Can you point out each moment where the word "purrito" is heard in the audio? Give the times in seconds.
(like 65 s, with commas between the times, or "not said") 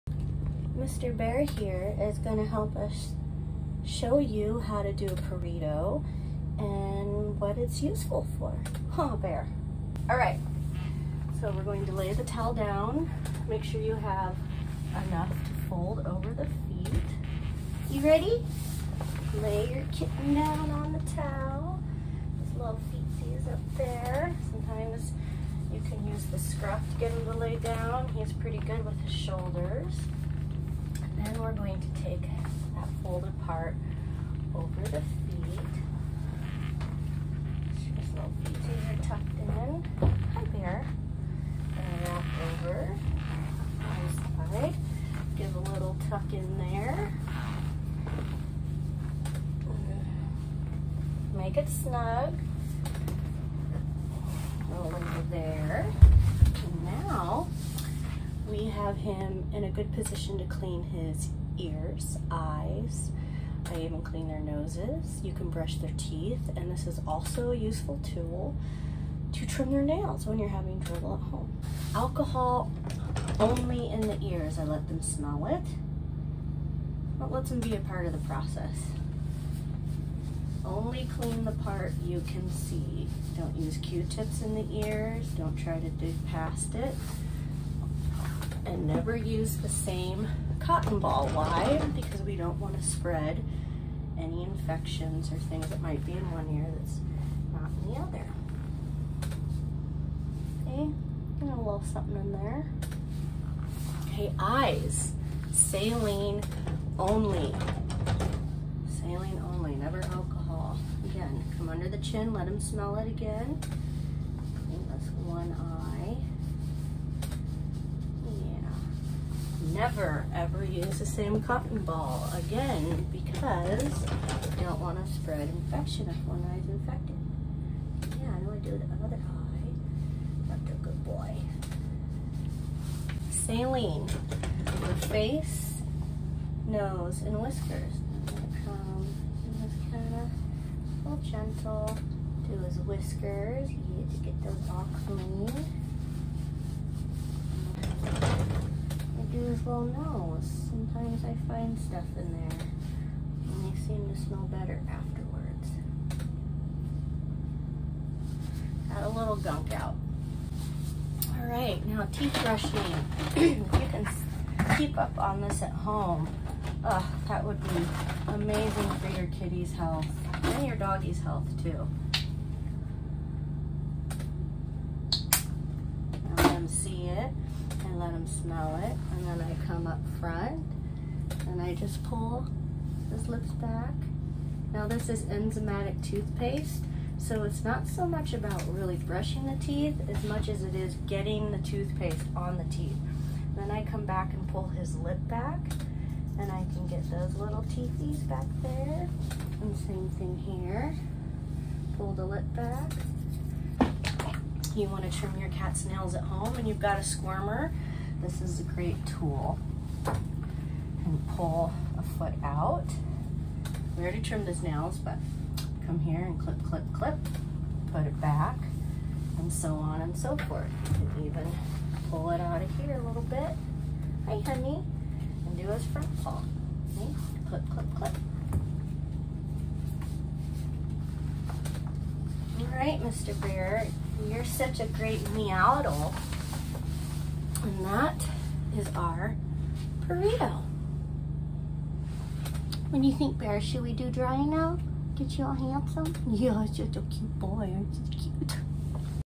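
5 s, 240 s.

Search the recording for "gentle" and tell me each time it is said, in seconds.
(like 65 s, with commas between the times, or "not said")
141 s.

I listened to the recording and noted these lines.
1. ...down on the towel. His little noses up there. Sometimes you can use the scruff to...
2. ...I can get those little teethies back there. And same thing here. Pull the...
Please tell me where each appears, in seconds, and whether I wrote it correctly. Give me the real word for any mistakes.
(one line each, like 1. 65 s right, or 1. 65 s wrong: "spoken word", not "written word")
1. 20 s wrong: "feetsies", not "noses"
2. 196 s right.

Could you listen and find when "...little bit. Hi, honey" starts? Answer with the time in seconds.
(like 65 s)
223 s.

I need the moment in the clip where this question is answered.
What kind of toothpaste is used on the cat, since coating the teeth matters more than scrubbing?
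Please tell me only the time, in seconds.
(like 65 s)
185 s.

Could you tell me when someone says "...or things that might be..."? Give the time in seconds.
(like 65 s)
95 s.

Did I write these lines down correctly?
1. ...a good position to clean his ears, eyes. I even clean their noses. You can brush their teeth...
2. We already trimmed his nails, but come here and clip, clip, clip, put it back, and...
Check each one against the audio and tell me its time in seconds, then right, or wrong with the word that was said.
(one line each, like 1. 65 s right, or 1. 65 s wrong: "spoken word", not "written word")
1. 59 s right
2. 213 s right.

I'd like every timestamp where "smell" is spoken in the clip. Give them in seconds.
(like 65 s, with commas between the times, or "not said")
75 s, 112 s, 154 s, 178 s.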